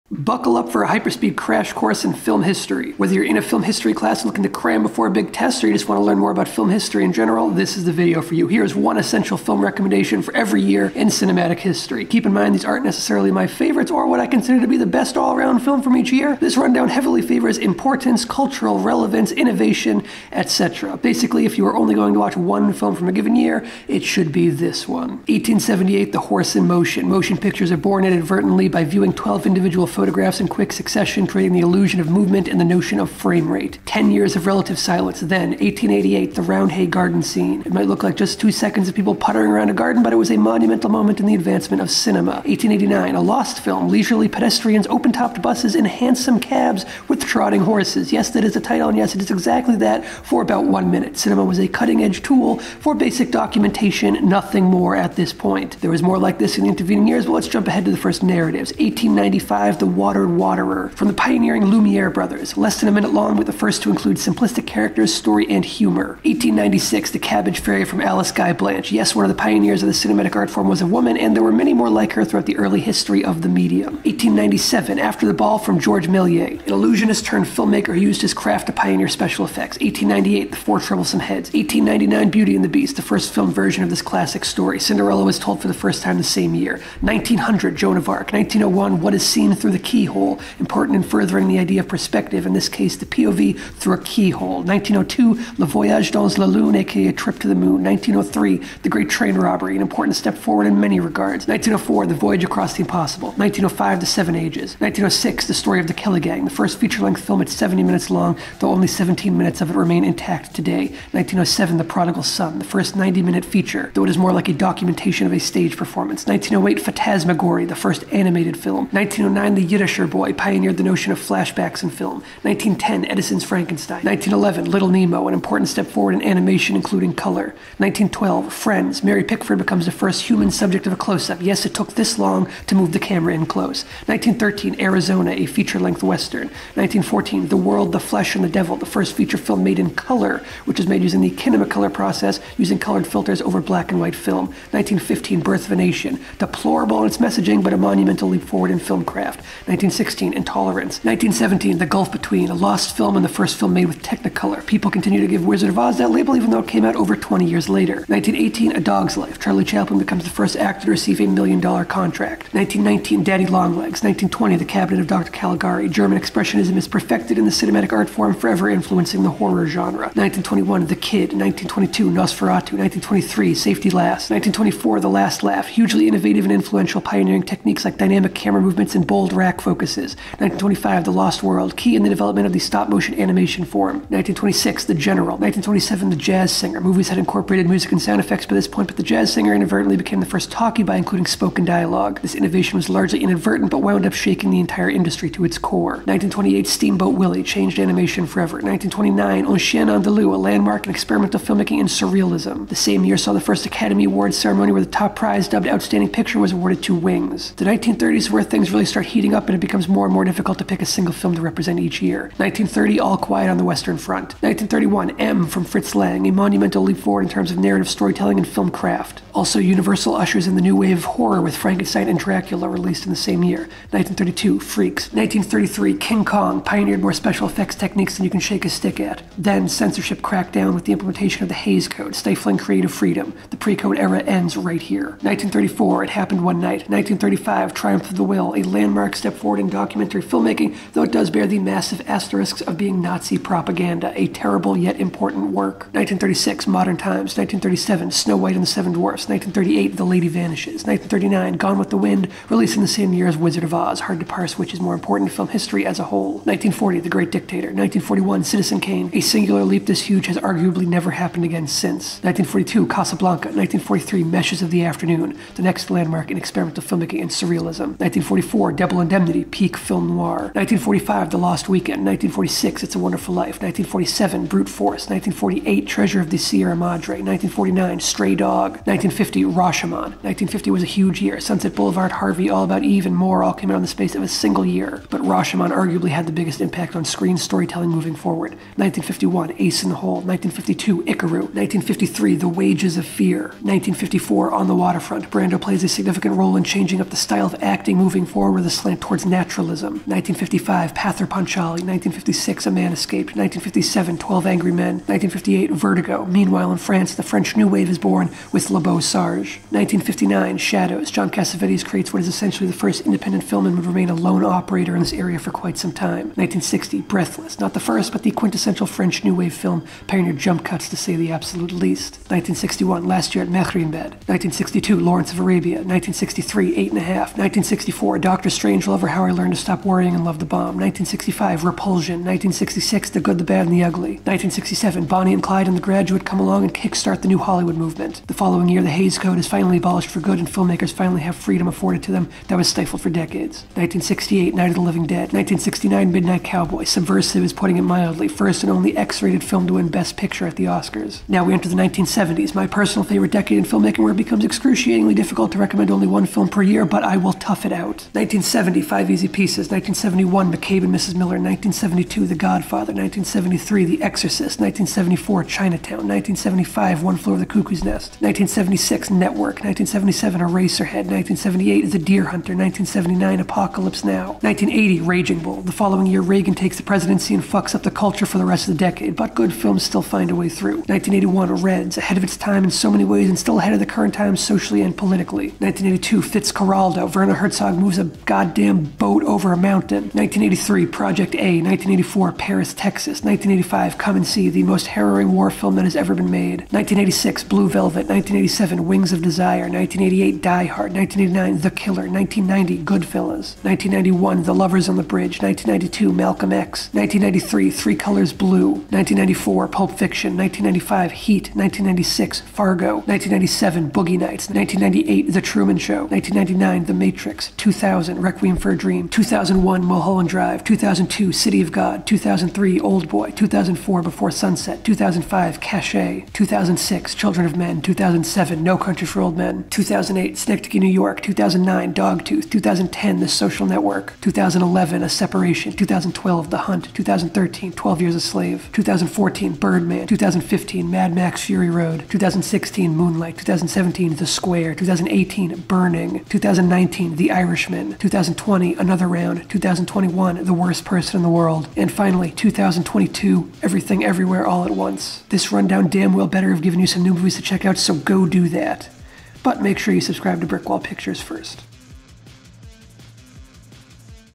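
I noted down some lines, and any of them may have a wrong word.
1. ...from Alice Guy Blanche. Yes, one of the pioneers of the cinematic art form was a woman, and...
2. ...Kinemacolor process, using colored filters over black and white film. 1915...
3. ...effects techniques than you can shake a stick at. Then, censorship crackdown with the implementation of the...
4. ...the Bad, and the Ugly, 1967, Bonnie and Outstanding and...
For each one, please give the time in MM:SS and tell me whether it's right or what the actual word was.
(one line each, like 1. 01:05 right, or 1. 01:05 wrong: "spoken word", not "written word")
1. 01:07 right
2. 02:21 right
3. 03:47 right
4. 05:33 wrong: "Clyde", not "Outstanding".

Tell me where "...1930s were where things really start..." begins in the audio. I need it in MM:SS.
03:27.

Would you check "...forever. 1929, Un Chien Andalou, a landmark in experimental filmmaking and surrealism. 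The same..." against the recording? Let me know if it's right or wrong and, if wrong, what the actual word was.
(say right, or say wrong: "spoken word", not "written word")
right.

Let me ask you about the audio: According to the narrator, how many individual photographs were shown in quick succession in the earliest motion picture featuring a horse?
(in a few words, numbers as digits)
12.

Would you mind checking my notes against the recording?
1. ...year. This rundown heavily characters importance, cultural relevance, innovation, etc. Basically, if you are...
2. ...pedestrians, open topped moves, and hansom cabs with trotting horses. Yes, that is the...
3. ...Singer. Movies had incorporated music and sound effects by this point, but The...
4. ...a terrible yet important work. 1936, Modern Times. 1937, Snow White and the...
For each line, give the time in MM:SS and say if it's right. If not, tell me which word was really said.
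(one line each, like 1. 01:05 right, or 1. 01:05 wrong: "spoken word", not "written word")
1. 00:16 wrong: "favors", not "characters"
2. 00:44 wrong: "buses", not "moves"
3. 03:06 right
4. 04:04 right.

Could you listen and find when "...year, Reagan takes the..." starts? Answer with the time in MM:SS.
06:16.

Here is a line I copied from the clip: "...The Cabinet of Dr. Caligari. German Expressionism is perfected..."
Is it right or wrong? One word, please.
right.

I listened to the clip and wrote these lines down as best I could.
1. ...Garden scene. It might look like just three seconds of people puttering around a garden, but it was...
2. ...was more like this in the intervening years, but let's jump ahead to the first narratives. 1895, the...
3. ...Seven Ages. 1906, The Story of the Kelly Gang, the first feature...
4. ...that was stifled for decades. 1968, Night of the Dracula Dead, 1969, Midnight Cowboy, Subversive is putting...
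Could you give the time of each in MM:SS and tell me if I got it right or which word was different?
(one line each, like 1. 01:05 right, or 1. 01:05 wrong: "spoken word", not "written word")
1. 00:36 wrong: "two", not "three"
2. 00:55 right
3. 01:44 right
4. 05:42 wrong: "Living", not "Dracula".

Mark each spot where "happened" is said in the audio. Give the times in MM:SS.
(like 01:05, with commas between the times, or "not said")
03:56, 04:21.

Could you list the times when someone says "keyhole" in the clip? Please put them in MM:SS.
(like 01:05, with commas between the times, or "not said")
01:29, 01:34.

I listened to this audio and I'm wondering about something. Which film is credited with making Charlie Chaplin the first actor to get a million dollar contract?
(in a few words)
A Dog's Life.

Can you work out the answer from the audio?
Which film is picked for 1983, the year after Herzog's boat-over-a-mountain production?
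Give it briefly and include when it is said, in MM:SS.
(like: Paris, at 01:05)
Project A, at 06:30.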